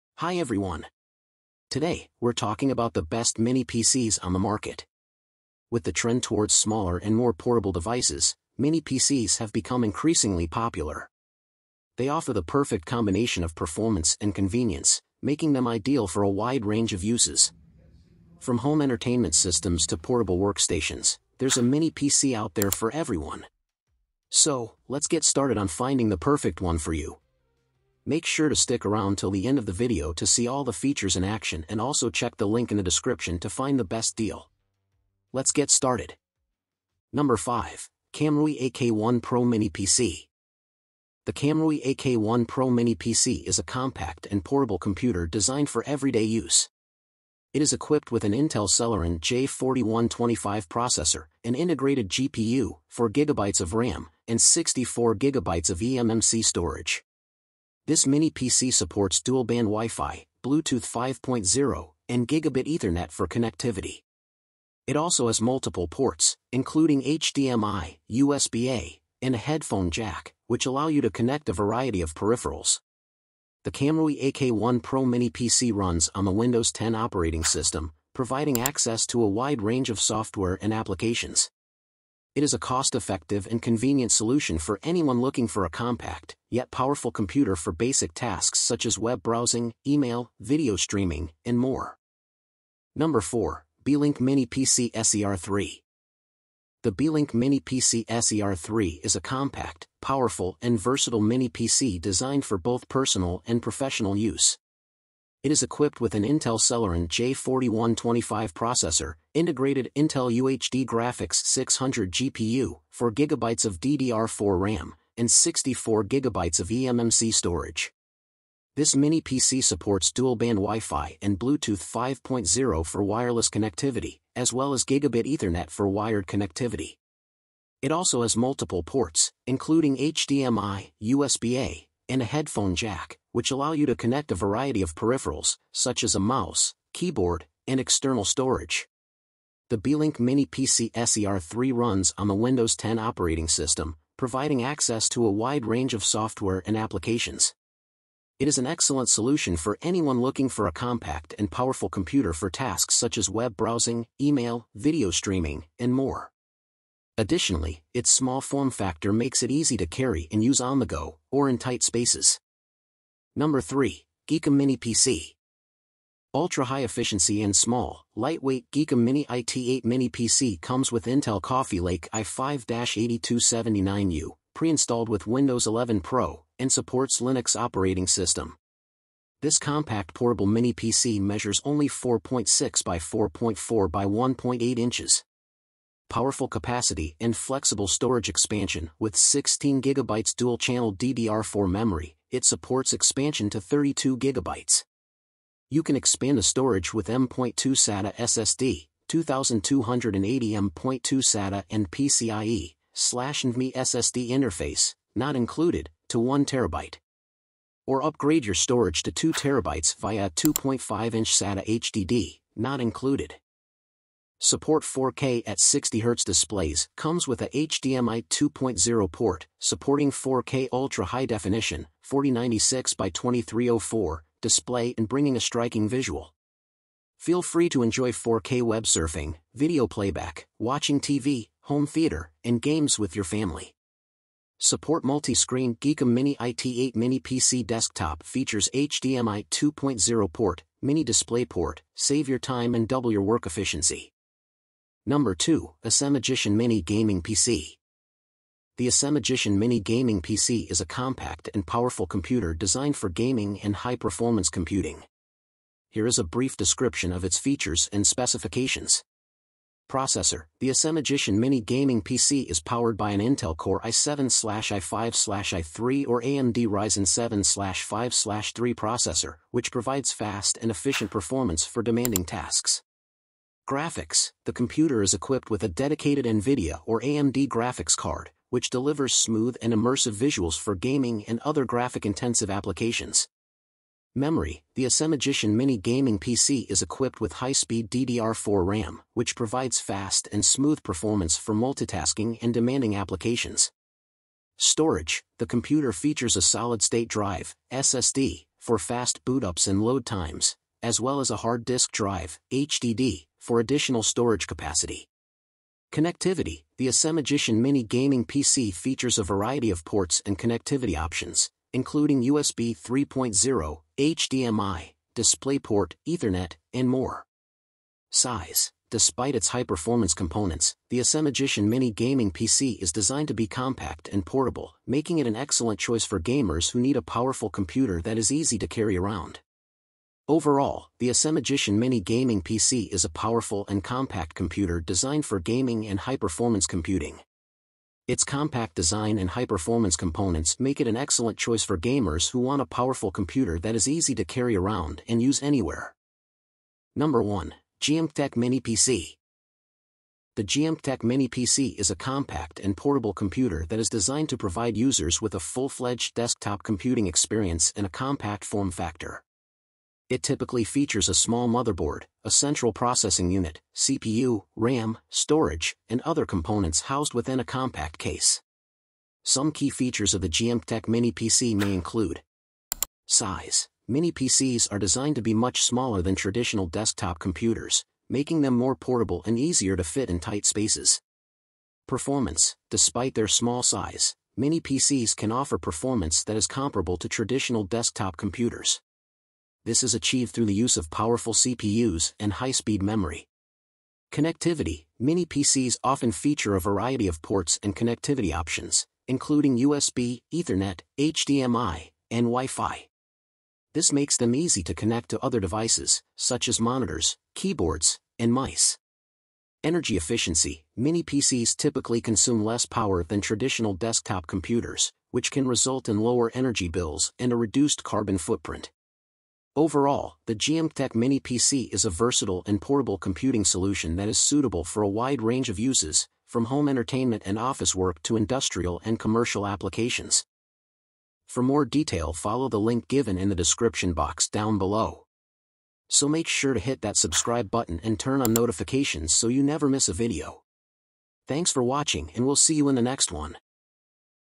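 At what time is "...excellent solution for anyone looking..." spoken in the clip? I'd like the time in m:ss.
2:28.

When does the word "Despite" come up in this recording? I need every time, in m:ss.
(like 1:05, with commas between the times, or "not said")
5:18, 6:22.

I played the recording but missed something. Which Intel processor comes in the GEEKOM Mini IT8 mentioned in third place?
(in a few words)
i5-8279U.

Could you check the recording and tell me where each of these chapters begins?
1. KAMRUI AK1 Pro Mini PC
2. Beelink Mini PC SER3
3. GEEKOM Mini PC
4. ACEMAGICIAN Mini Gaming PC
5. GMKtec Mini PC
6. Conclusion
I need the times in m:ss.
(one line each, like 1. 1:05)
1. 0:37
2. 1:33
3. 2:43
4. 4:05
5. 5:47
6. 7:11.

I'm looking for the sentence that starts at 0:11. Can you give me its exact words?
They offer the perfect combination of performance and convenience, making them ideal for a wide range of uses.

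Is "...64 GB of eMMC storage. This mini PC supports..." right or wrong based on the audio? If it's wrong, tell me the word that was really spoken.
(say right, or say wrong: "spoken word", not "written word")
right.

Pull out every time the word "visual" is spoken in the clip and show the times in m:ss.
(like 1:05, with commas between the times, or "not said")
3:45, 4:40.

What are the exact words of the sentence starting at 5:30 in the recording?
Overall, the ACEMAGICIAN Mini Gaming PC is a powerful and compact computer designed for gaming and high-performance computing.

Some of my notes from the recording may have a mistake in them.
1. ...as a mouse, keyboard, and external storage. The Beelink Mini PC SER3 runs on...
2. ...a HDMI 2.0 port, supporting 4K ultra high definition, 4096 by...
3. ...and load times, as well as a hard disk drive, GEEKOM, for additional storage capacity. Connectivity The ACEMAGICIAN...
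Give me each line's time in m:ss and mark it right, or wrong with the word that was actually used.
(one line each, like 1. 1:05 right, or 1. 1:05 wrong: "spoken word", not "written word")
1. 2:16 right
2. 3:37 right
3. 4:59 wrong: "HDD", not "GEEKOM".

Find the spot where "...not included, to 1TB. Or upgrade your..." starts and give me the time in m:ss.
3:25.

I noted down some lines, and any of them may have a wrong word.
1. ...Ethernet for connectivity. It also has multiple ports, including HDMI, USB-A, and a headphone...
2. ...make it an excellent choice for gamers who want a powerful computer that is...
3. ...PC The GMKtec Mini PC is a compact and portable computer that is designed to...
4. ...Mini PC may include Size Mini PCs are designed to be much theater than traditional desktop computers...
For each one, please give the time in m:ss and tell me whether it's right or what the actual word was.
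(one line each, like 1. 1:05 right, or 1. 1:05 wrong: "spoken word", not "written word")
1. 1:02 right
2. 5:40 right
3. 5:48 right
4. 6:10 wrong: "smaller", not "theater".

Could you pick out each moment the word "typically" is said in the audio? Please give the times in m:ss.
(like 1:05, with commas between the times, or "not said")
6:00, 6:51.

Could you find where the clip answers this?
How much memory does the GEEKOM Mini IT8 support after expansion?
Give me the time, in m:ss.
3:13.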